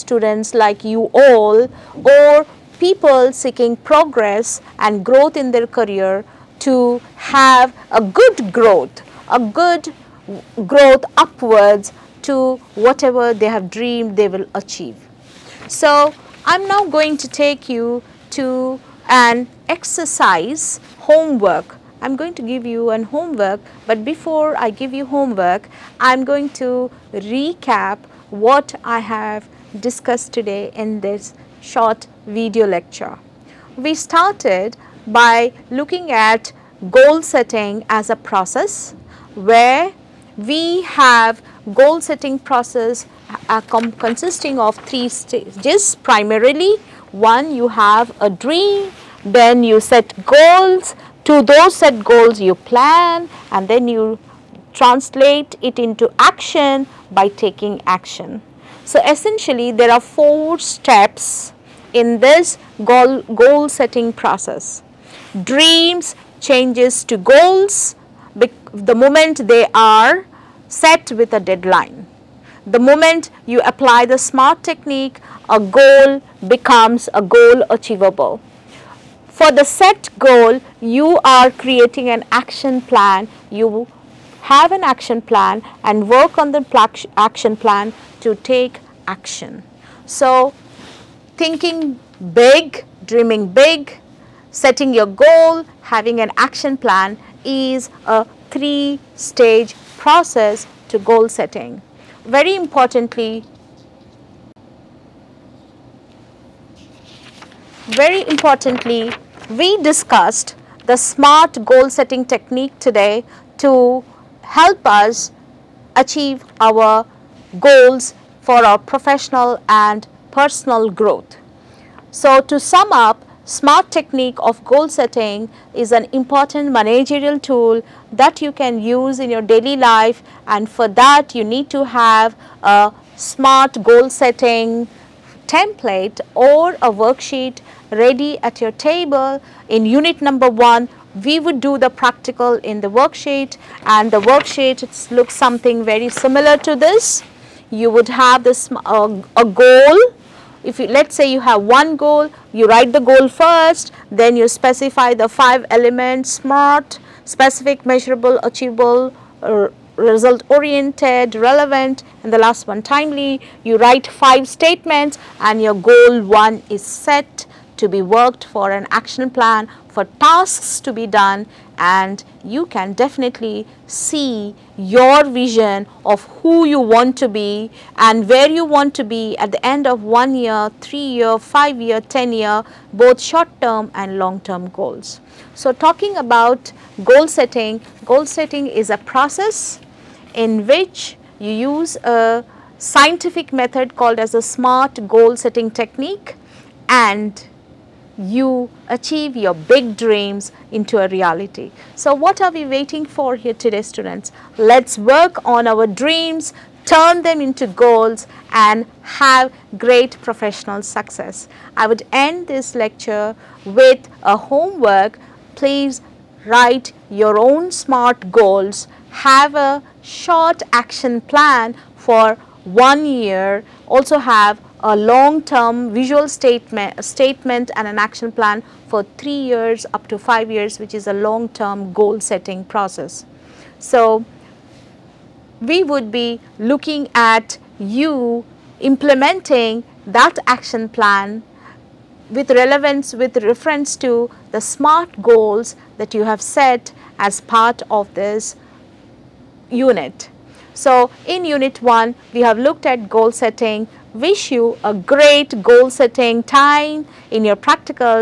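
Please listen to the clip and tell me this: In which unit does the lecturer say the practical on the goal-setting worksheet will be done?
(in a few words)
unit 1.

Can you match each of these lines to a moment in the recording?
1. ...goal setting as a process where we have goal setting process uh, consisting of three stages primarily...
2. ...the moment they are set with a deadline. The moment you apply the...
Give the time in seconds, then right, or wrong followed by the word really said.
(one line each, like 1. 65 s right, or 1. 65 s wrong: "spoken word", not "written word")
1. 36 s right
2. 68 s right.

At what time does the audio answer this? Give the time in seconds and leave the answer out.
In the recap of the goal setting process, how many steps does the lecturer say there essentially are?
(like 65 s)
59 s.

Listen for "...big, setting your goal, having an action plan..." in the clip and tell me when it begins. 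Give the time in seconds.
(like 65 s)
93 s.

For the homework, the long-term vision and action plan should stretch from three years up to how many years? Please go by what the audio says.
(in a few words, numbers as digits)
5.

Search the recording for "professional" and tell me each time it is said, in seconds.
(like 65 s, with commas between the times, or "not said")
118 s, 210 s.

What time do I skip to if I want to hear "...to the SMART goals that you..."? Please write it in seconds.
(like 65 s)
243 s.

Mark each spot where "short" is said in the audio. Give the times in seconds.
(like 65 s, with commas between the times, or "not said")
31 s, 183 s, 220 s.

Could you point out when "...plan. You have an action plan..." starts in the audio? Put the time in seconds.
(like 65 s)
82 s.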